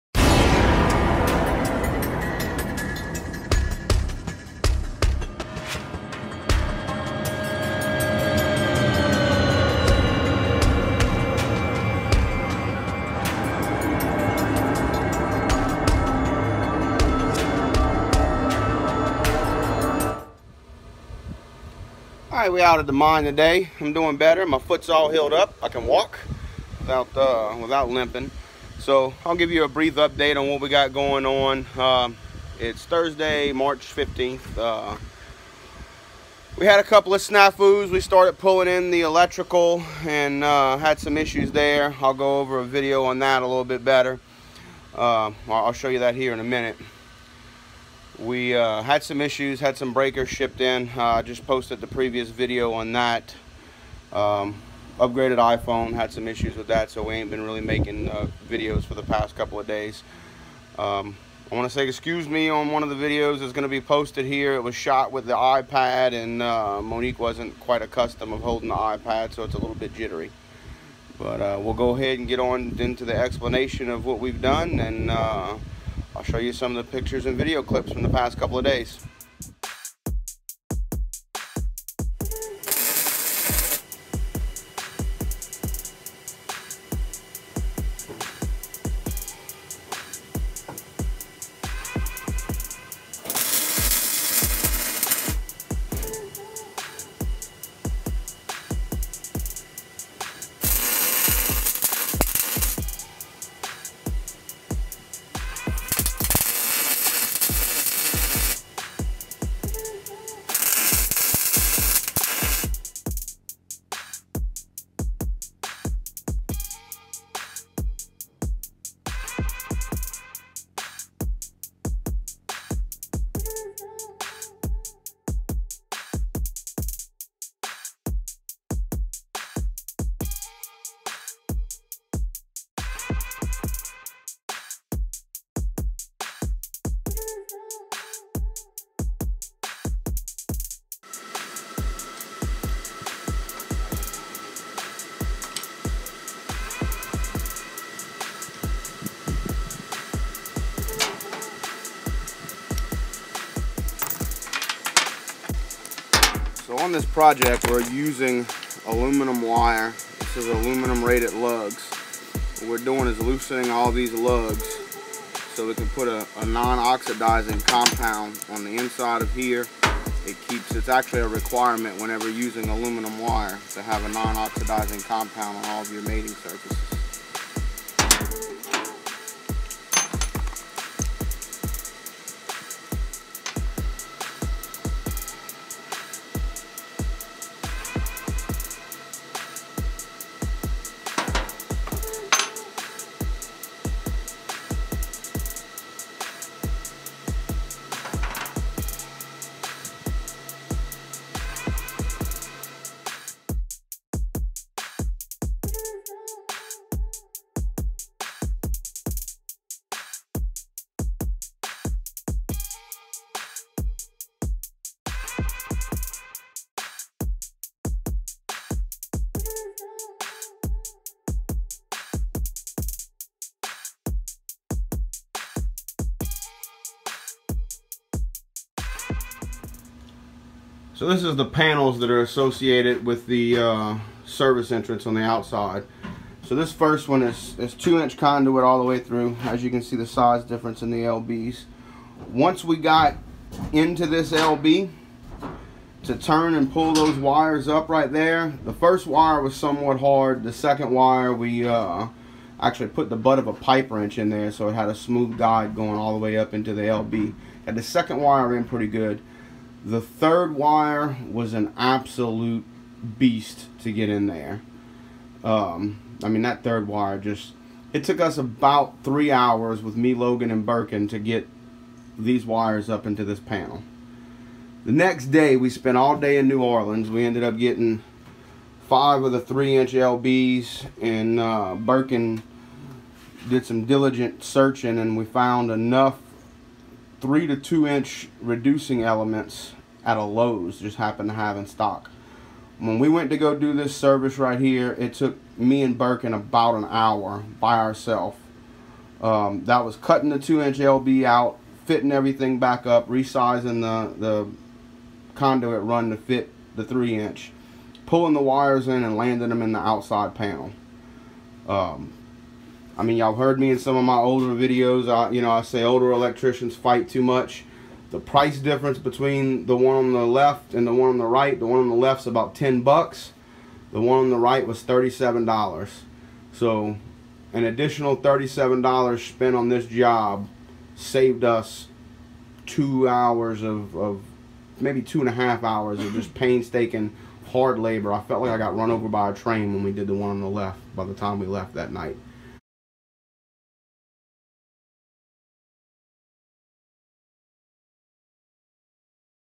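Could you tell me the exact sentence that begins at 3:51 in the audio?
So this is the panels that are associated with the uh, service entrance on the outside.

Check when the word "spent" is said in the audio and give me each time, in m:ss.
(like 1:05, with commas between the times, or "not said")
4:35, 5:29.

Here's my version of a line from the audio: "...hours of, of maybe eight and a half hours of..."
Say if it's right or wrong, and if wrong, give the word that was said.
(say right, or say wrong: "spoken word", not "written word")
wrong: "two", not "eight".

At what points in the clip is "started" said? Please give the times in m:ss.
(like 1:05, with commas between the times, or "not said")
0:37.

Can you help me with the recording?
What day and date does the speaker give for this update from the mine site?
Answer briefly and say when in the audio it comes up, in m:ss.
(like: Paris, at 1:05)
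Thursday, March 15th, at 0:32.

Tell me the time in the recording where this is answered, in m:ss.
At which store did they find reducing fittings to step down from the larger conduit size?
4:50.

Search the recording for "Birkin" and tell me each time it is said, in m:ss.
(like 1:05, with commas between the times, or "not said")
4:30, 4:41, 4:55.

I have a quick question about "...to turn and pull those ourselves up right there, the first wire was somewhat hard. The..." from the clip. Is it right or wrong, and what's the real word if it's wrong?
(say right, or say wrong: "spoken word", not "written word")
wrong: "wires", not "ourselves".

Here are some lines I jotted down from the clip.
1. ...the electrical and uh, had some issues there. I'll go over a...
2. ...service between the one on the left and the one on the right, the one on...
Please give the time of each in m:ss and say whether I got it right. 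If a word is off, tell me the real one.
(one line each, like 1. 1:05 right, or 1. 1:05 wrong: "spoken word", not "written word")
1. 0:38 right
2. 5:18 wrong: "difference", not "service".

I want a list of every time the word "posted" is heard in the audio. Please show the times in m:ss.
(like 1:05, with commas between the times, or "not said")
0:51, 1:03.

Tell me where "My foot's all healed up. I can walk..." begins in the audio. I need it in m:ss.
0:24.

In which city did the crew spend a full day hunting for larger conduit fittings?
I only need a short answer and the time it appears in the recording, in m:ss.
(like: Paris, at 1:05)
New Orleans, at 4:36.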